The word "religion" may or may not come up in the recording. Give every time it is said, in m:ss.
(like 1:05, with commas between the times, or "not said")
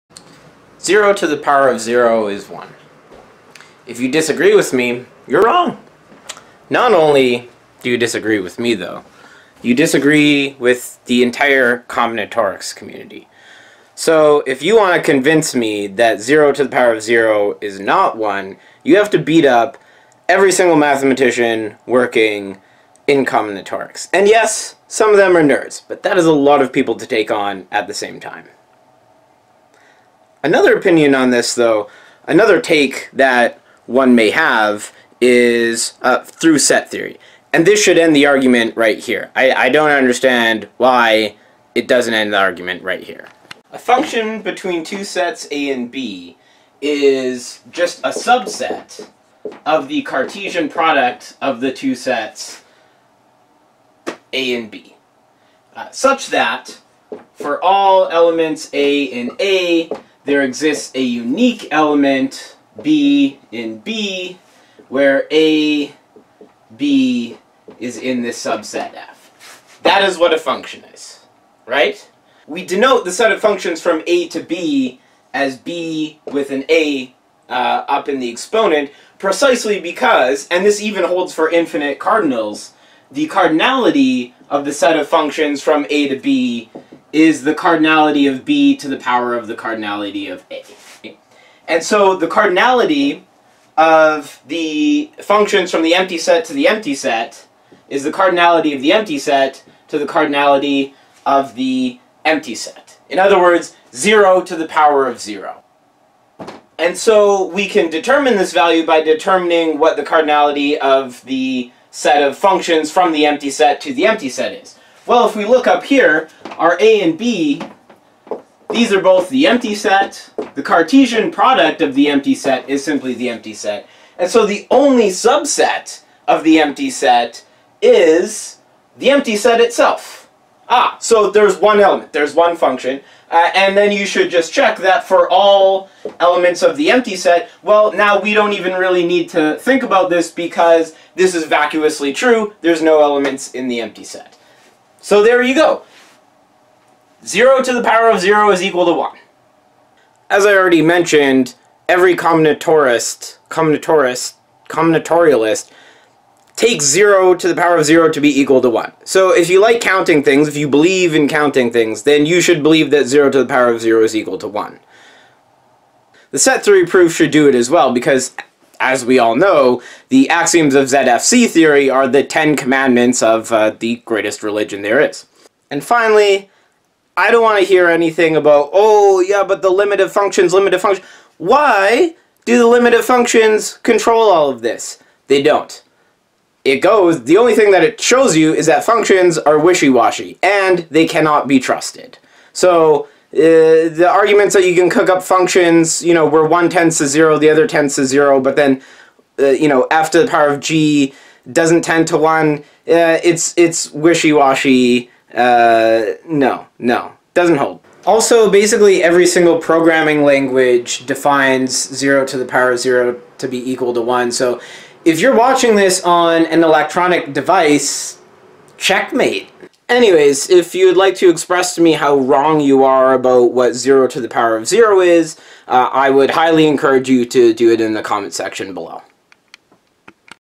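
2:54.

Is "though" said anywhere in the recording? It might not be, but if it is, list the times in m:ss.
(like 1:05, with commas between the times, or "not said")
0:08, 0:31.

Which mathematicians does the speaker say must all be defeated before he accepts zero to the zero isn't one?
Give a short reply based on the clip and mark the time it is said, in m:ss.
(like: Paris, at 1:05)
Combinatorics community, at 0:11.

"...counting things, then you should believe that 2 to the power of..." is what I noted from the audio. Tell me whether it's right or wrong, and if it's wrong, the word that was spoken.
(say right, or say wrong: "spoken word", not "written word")
wrong: "0", not "2".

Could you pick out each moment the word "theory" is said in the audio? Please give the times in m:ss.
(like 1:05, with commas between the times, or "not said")
0:36, 2:46, 2:51.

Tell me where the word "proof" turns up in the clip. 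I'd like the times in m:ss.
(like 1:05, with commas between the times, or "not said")
2:46.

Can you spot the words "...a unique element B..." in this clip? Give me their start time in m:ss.
1:00.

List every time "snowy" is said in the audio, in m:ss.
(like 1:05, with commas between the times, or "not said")
not said.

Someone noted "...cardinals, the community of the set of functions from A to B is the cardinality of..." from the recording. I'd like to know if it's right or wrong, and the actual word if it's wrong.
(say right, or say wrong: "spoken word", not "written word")
wrong: "cardinality", not "community".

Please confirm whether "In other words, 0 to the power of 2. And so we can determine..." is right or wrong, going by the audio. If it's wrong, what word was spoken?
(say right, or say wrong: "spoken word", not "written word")
wrong: "0", not "2".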